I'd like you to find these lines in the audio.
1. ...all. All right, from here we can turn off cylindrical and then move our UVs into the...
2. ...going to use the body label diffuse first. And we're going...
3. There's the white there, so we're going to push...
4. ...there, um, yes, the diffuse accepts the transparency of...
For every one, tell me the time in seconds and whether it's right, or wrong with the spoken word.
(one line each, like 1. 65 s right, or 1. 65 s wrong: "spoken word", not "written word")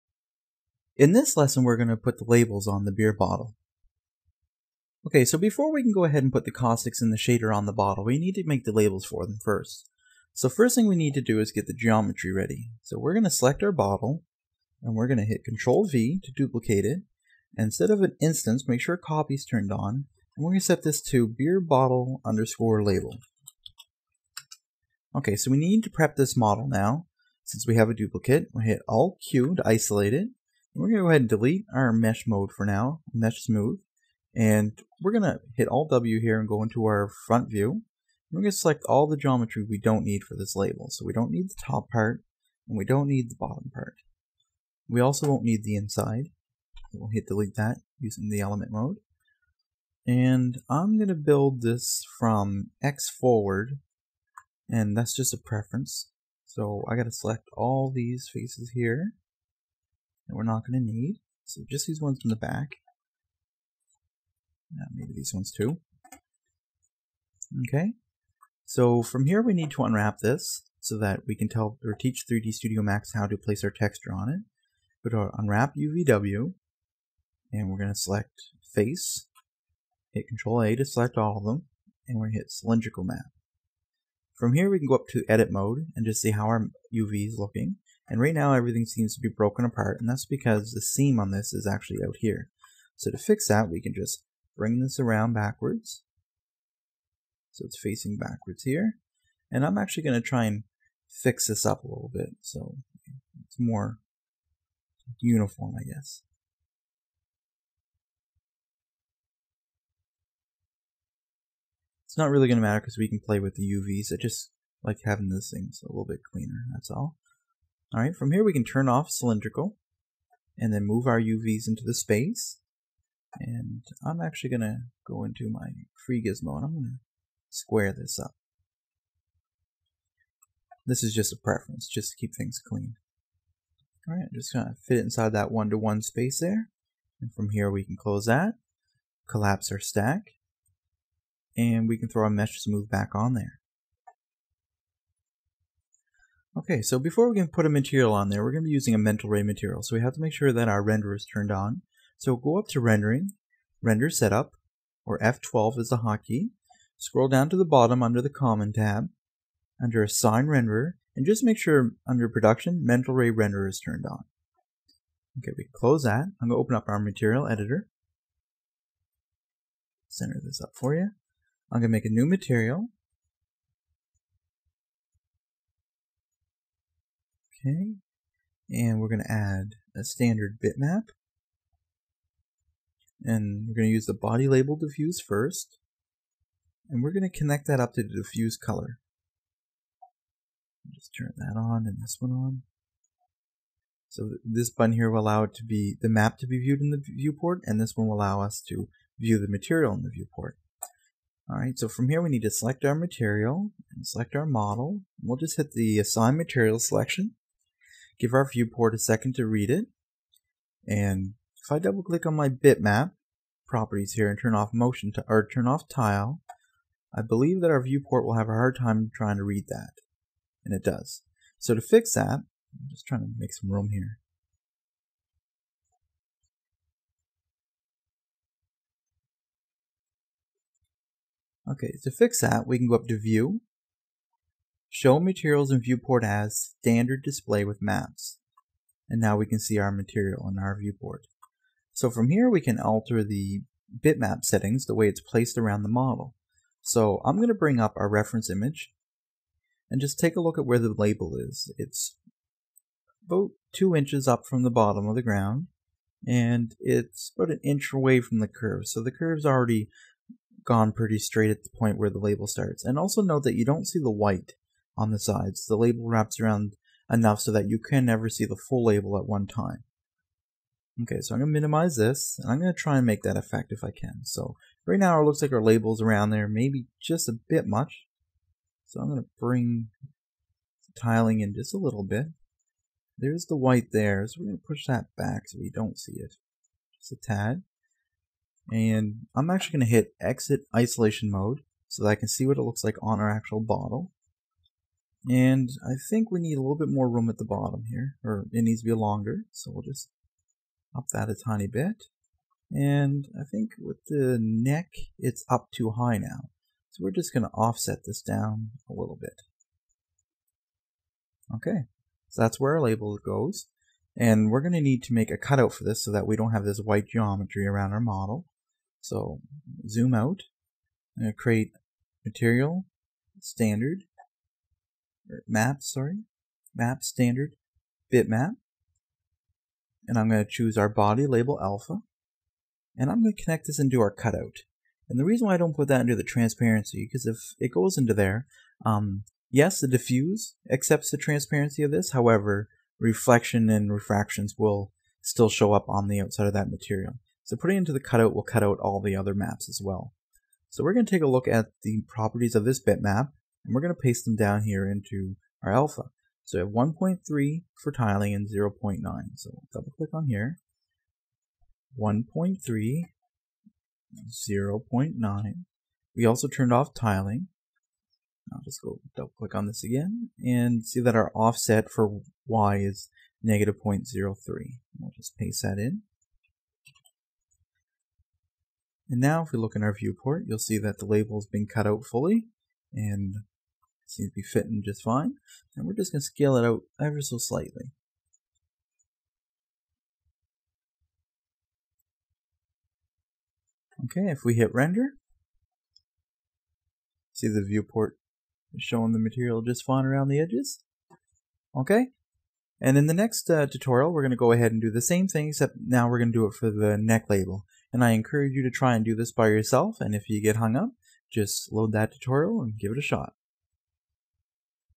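1. 116 s right
2. 183 s right
3. 283 s right
4. 338 s right.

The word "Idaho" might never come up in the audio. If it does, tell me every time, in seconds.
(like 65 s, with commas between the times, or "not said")
not said.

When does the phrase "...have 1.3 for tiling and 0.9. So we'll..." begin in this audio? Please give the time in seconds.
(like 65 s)
356 s.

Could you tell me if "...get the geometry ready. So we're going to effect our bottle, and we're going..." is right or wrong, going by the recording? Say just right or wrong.
wrong.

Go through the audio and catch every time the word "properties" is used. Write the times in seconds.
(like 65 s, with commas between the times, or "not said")
213 s, 352 s.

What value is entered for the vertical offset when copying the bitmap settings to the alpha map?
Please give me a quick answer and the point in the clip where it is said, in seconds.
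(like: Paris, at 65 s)
-0.03, at 373 s.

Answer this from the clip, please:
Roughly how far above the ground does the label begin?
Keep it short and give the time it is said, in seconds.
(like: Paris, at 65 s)
2 inches, at 253 s.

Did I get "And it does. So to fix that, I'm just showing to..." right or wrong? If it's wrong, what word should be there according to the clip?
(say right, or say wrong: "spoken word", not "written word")
wrong: "trying", not "showing".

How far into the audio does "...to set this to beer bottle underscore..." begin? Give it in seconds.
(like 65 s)
20 s.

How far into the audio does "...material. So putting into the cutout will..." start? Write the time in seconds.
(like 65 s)
346 s.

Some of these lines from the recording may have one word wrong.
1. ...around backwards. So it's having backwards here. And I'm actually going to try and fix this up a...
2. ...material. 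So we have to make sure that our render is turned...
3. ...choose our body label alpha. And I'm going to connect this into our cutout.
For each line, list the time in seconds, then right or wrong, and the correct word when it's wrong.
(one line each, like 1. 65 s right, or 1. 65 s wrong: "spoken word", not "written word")
1. 94 s wrong: "facing", not "having"
2. 149 s right
3. 330 s right.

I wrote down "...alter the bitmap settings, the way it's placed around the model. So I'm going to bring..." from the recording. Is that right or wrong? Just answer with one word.
right.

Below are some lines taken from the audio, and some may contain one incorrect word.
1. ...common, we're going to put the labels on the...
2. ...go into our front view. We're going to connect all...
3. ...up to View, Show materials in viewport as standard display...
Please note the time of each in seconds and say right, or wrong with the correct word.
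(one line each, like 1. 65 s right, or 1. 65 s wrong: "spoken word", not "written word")
1. 1 s wrong: "lesson", not "common"
2. 36 s wrong: "select", not "connect"
3. 232 s right.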